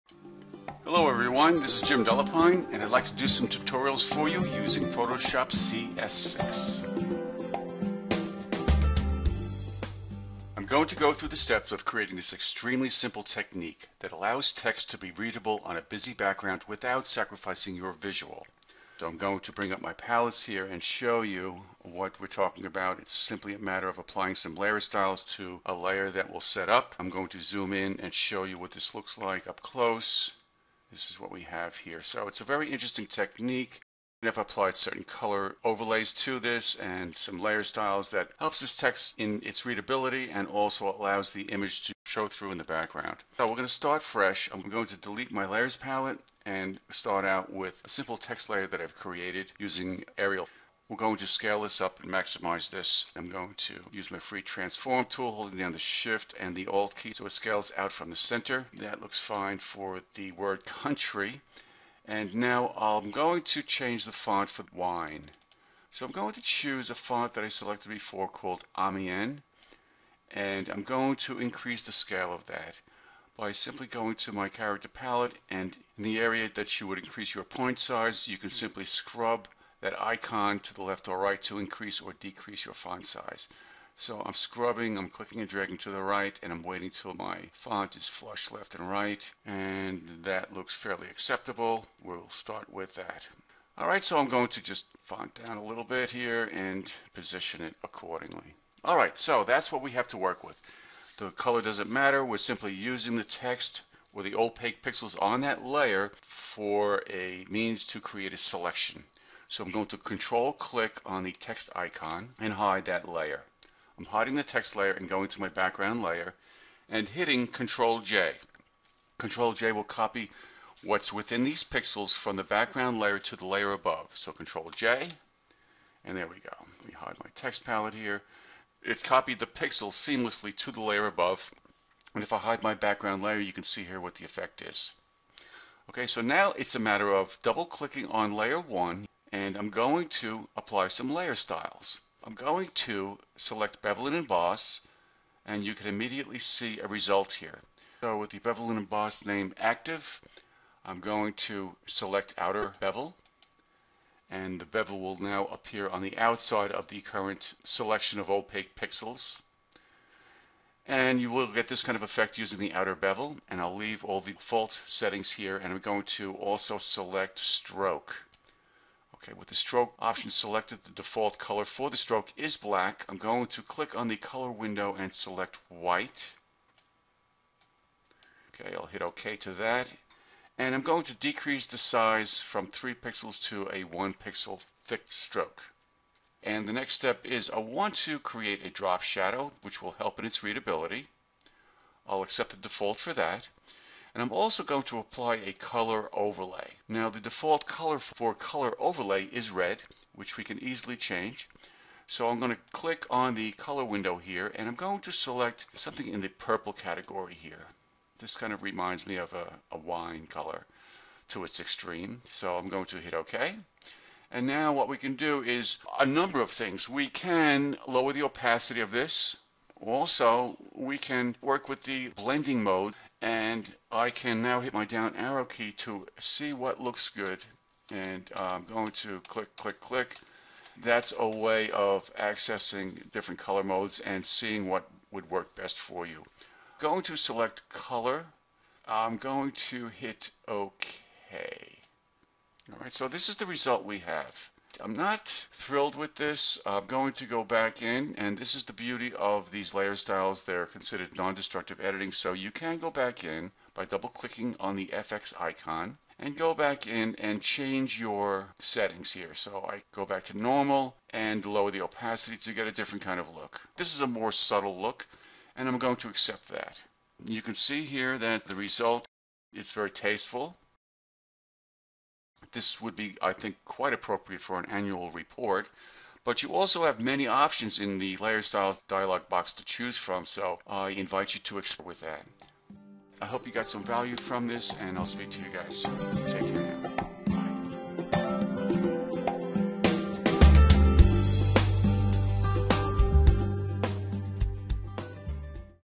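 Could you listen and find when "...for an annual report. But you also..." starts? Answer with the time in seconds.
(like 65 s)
274 s.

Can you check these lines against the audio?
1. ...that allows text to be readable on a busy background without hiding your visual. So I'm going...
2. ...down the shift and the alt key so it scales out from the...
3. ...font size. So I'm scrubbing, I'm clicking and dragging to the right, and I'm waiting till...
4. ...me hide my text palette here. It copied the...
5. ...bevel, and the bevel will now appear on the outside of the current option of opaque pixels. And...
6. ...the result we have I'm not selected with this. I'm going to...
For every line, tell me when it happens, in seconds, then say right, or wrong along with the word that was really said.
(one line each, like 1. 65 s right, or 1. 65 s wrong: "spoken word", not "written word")
1. 13 s wrong: "sacrificing", not "hiding"
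2. 55 s right
3. 82 s right
4. 126 s right
5. 152 s wrong: "selection", not "option"
6. 243 s wrong: "thrilled", not "selected".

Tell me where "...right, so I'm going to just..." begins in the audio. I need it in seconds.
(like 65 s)
93 s.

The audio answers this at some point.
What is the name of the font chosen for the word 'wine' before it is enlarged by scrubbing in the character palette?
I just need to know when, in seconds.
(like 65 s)
68 s.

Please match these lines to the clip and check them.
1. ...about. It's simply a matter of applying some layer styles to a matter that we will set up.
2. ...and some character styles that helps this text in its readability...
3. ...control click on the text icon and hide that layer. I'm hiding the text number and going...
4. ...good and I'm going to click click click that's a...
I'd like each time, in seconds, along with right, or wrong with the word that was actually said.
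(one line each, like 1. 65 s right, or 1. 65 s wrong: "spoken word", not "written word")
1. 22 s wrong: "layer", not "matter"
2. 36 s wrong: "layer", not "character"
3. 109 s wrong: "layer", not "number"
4. 227 s right.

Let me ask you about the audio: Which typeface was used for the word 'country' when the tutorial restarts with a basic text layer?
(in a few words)
Arial.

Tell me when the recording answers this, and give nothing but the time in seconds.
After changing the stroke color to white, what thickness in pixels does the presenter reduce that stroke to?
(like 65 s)
183 s.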